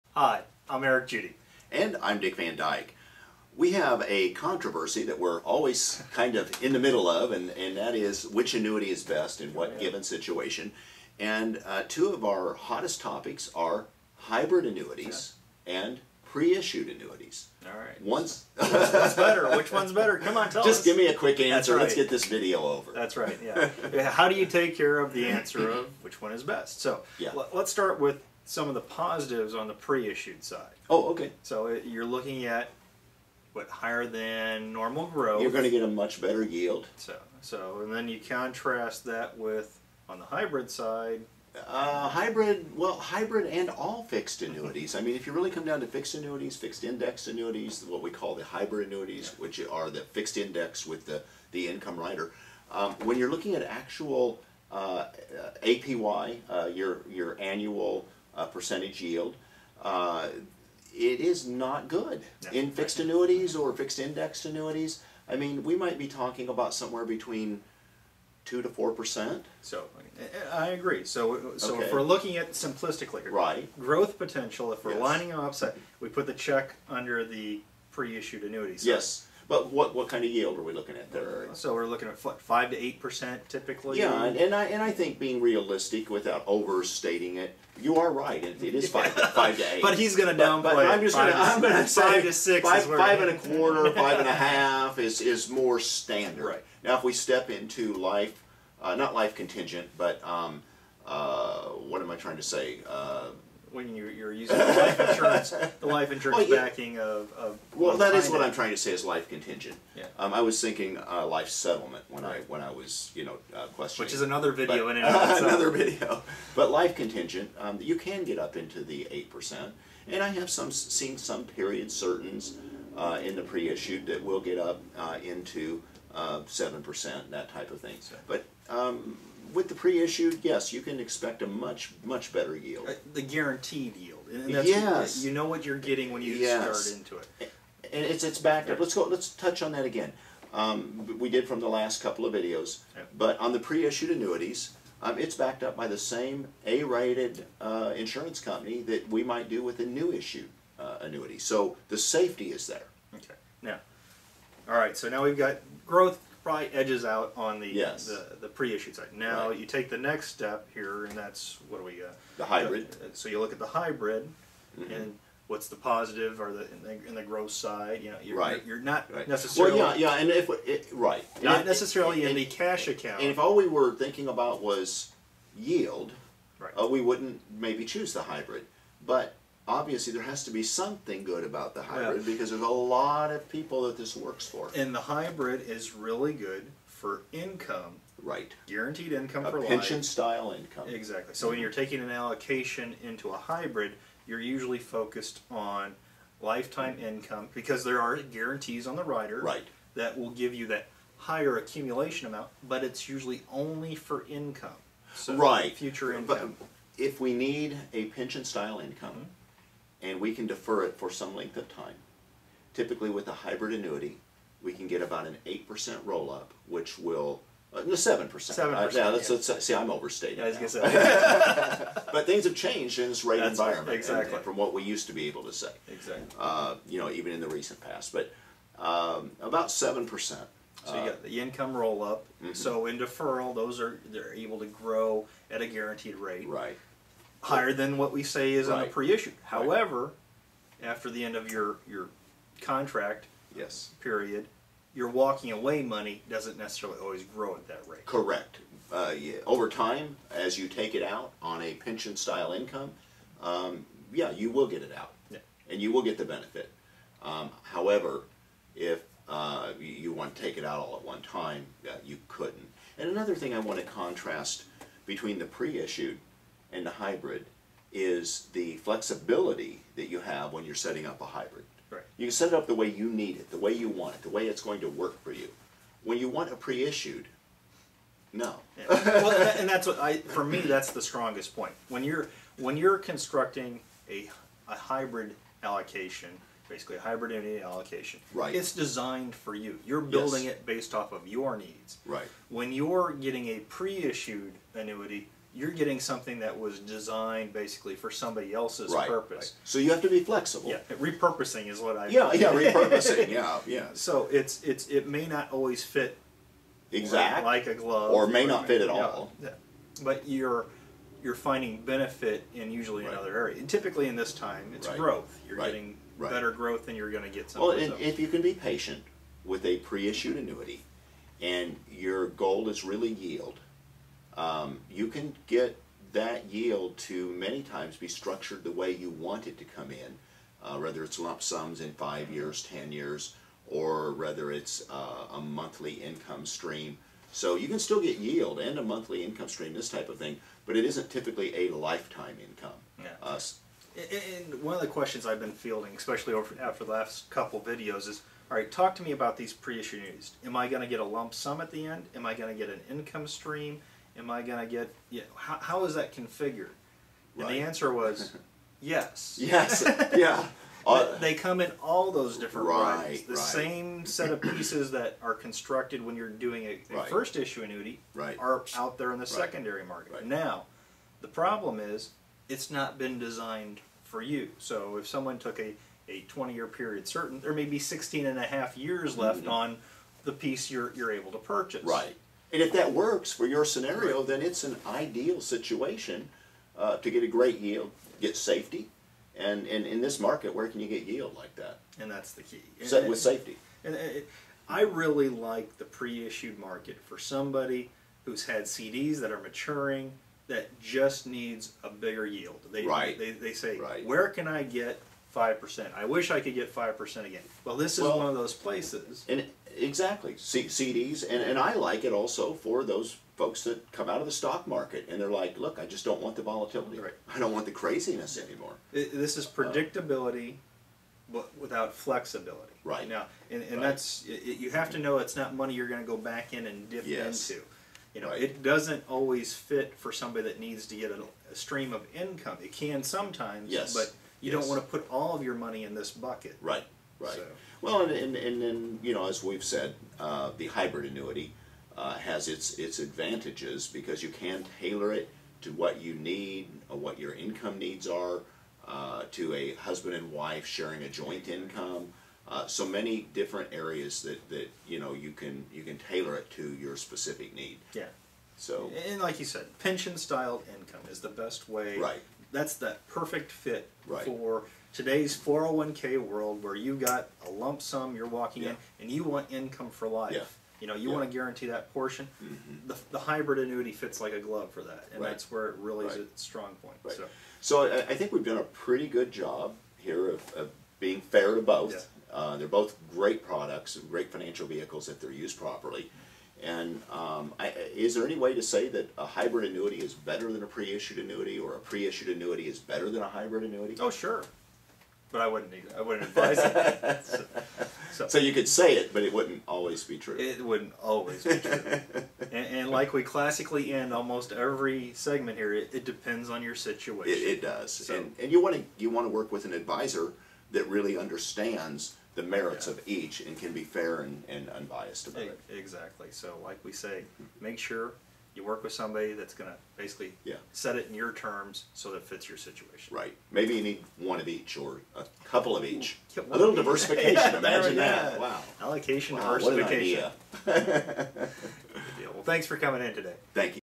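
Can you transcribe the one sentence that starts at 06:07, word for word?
first issue annuity are out there in the secondary market.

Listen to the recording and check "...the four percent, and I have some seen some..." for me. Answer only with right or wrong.
wrong.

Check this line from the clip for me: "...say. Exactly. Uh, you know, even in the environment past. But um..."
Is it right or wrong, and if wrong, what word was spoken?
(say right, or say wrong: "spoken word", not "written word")
wrong: "recent", not "environment".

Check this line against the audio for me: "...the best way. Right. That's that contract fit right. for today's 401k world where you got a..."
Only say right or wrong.
wrong.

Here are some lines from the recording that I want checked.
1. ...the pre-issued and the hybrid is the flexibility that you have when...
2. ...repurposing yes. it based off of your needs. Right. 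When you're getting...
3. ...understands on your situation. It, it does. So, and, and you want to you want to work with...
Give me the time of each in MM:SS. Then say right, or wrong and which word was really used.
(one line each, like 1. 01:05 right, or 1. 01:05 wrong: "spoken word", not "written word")
1. 04:25 right
2. 04:49 wrong: "building", not "repurposing"
3. 08:26 wrong: "depends", not "understands".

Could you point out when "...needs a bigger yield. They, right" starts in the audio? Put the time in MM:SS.
06:41.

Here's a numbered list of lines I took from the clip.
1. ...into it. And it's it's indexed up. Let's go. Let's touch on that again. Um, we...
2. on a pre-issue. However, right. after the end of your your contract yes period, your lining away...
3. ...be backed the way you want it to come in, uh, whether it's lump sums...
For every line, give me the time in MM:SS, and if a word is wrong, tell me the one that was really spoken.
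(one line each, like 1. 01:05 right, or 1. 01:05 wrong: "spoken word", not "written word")
1. 02:16 wrong: "backed", not "indexed"
2. 03:58 wrong: "walking", not "lining"
3. 05:27 wrong: "structured", not "backed".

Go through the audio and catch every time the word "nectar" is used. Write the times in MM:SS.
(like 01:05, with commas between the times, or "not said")
not said.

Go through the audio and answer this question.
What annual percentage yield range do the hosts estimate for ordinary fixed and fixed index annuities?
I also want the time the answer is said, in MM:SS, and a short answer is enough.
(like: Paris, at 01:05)
2 to 4 percent, at 01:08.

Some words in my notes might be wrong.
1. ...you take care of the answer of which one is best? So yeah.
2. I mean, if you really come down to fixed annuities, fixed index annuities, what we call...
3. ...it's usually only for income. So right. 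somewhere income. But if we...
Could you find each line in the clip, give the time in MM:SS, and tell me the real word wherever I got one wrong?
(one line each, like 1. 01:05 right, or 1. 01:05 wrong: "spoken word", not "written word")
1. 00:24 right
2. 00:44 right
3. 03:22 wrong: "future", not "somewhere".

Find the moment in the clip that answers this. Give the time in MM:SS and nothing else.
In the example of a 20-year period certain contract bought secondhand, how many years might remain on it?
06:17.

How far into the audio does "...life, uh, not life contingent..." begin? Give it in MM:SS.
01:37.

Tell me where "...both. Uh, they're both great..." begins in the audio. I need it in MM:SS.
08:01.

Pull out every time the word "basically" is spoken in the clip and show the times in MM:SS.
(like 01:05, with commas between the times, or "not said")
04:46, 04:57, 08:39.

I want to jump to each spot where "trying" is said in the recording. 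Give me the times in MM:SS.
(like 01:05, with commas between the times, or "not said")
01:42, 01:48.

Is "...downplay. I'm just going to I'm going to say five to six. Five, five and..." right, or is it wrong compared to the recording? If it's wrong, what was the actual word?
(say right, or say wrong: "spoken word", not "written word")
right.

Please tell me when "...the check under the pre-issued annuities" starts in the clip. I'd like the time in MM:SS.
01:16.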